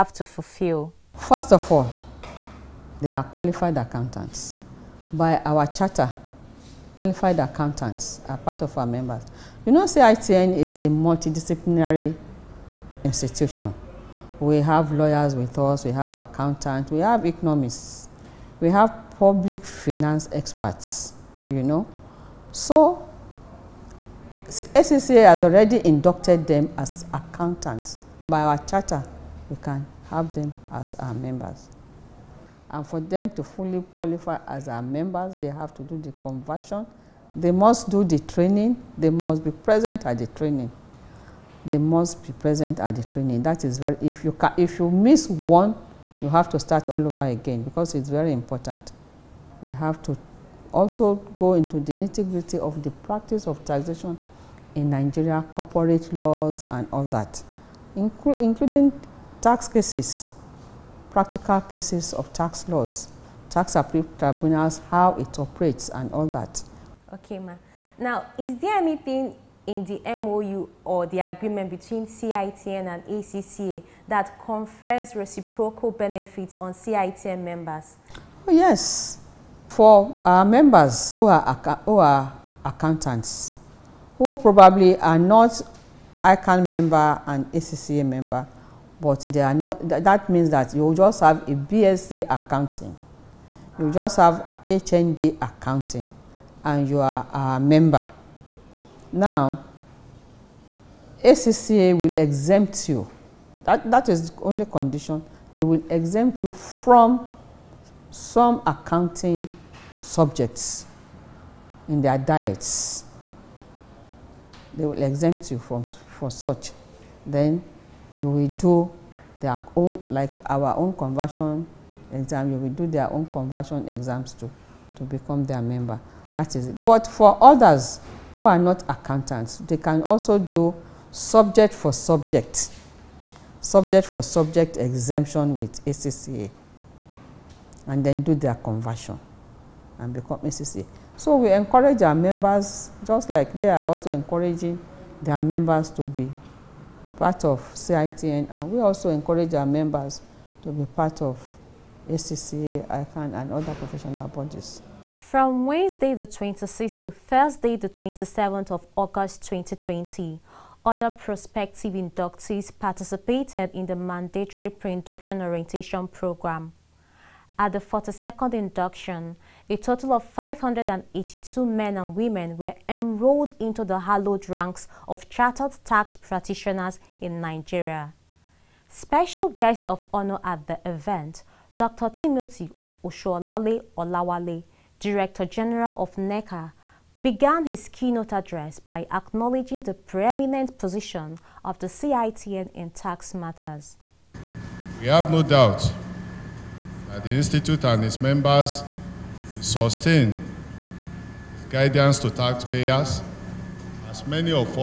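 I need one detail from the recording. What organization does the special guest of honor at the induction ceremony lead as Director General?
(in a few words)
NECA.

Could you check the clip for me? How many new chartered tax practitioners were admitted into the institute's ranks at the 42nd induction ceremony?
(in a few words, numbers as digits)
582.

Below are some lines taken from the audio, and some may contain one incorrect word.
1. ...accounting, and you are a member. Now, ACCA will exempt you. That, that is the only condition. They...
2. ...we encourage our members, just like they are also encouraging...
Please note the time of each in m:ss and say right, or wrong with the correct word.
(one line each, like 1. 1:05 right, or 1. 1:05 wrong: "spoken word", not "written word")
1. 1:35 right
2. 2:21 right.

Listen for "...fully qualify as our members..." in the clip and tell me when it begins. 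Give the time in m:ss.
0:33.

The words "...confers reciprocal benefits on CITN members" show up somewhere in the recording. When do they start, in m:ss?
1:14.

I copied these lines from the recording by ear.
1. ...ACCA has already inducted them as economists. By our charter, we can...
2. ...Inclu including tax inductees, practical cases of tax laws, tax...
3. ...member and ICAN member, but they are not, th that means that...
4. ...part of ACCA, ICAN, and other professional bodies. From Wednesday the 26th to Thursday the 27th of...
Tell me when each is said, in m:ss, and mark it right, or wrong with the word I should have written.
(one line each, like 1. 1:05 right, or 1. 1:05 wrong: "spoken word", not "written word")
1. 0:24 wrong: "accountants", not "economists"
2. 0:57 wrong: "cases", not "inductees"
3. 1:26 wrong: "ACCA", not "ICAN"
4. 2:30 right.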